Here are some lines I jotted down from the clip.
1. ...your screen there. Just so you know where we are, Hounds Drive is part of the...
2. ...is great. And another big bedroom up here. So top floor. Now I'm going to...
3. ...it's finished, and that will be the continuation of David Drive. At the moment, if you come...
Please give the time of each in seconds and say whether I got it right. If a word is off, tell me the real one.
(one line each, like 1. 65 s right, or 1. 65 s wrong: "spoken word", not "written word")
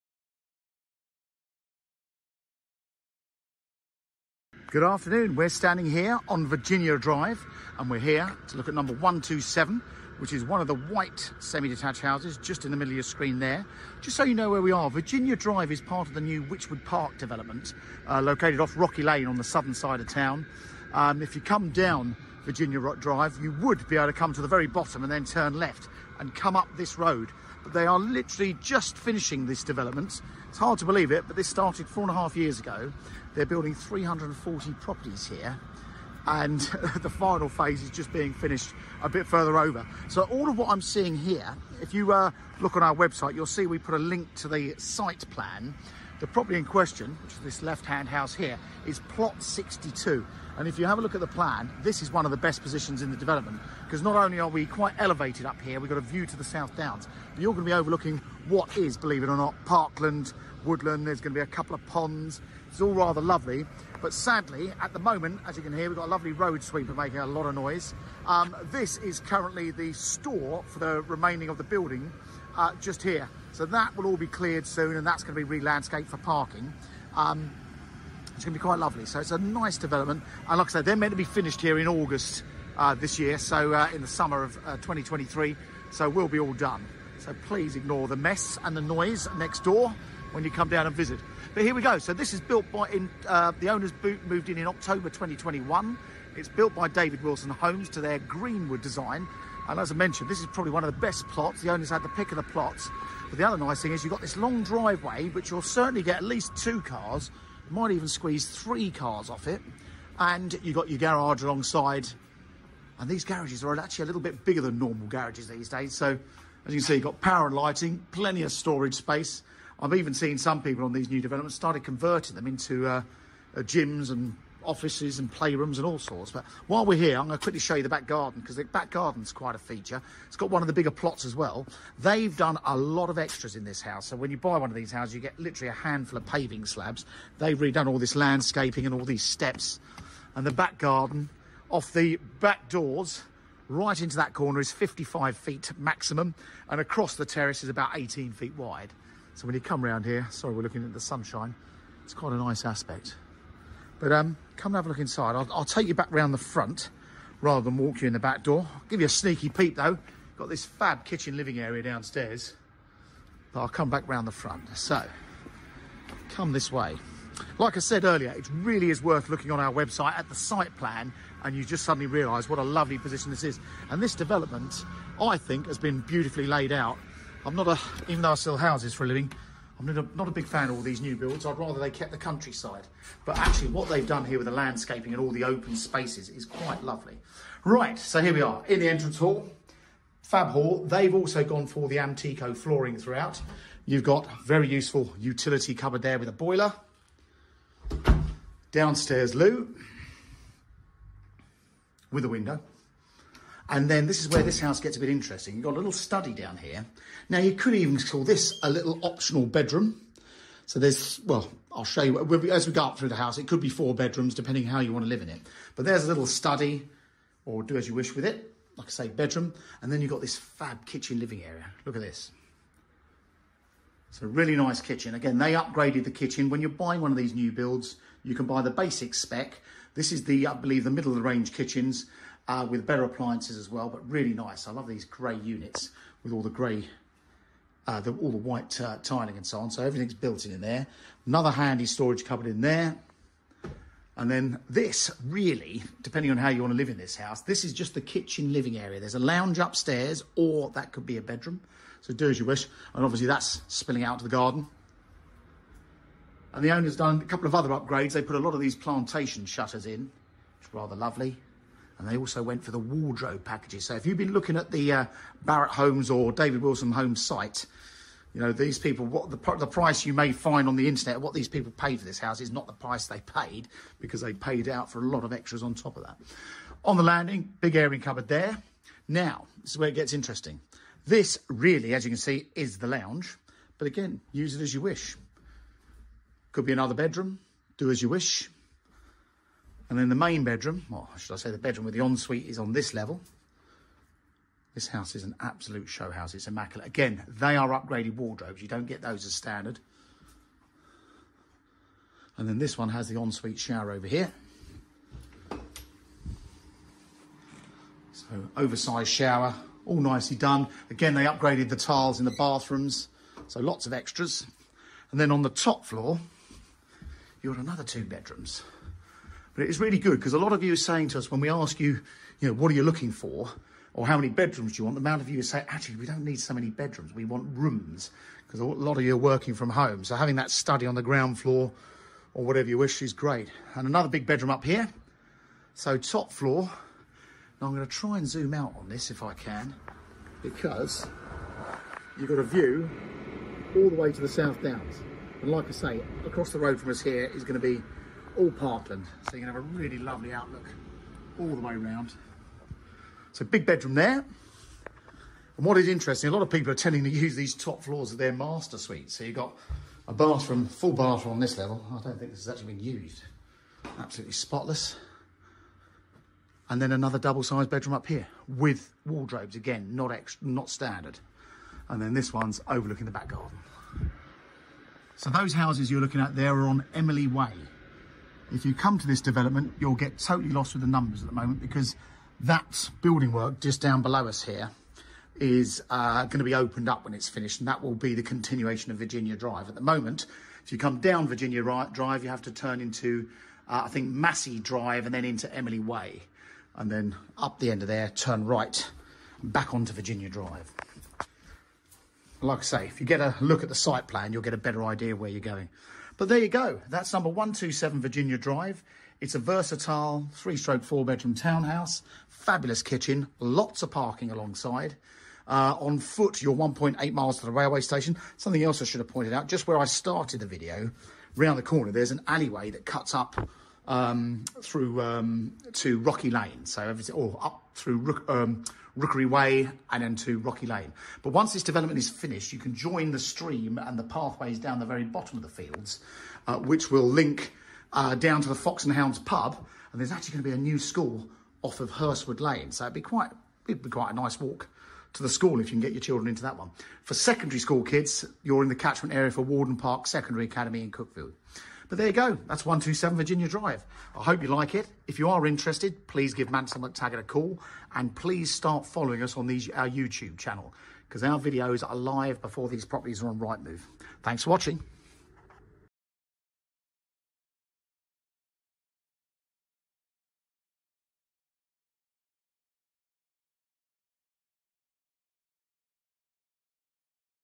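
1. 12 s wrong: "Virginia", not "Hounds"
2. 333 s right
3. 387 s wrong: "Virginia", not "David".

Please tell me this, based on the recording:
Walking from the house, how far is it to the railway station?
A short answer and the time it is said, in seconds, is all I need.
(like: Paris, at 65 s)
1.8 miles, at 416 s.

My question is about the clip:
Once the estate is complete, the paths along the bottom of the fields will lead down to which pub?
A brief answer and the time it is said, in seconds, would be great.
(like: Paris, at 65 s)
Fox and Hounds, at 438 s.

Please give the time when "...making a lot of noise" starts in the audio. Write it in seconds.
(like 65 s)
66 s.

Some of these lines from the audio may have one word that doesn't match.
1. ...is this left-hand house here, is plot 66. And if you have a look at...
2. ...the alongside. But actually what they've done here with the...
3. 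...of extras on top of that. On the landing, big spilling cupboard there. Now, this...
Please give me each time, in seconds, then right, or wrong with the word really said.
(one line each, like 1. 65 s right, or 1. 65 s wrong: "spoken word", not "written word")
1. 47 s wrong: "62", not "66"
2. 182 s wrong: "countryside", not "alongside"
3. 275 s wrong: "airing", not "spilling".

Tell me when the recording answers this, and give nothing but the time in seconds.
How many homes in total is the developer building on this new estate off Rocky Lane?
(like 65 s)
33 s.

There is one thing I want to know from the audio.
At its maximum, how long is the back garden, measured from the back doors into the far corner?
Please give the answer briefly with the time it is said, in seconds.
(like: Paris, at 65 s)
55 feet, at 144 s.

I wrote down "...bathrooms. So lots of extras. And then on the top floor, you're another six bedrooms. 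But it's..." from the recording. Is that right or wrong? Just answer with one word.
wrong.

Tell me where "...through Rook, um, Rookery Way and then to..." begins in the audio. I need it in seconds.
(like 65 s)
427 s.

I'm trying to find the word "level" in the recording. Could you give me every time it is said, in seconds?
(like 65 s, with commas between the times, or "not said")
292 s, 361 s.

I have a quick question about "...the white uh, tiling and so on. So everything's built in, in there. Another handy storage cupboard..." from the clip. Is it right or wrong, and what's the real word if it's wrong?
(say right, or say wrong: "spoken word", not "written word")
right.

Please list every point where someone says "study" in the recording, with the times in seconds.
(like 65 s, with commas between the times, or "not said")
205 s, 216 s, 330 s.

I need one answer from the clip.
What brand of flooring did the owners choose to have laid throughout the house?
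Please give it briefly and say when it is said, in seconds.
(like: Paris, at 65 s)
Amtico, at 191 s.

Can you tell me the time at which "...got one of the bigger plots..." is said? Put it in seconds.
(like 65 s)
130 s.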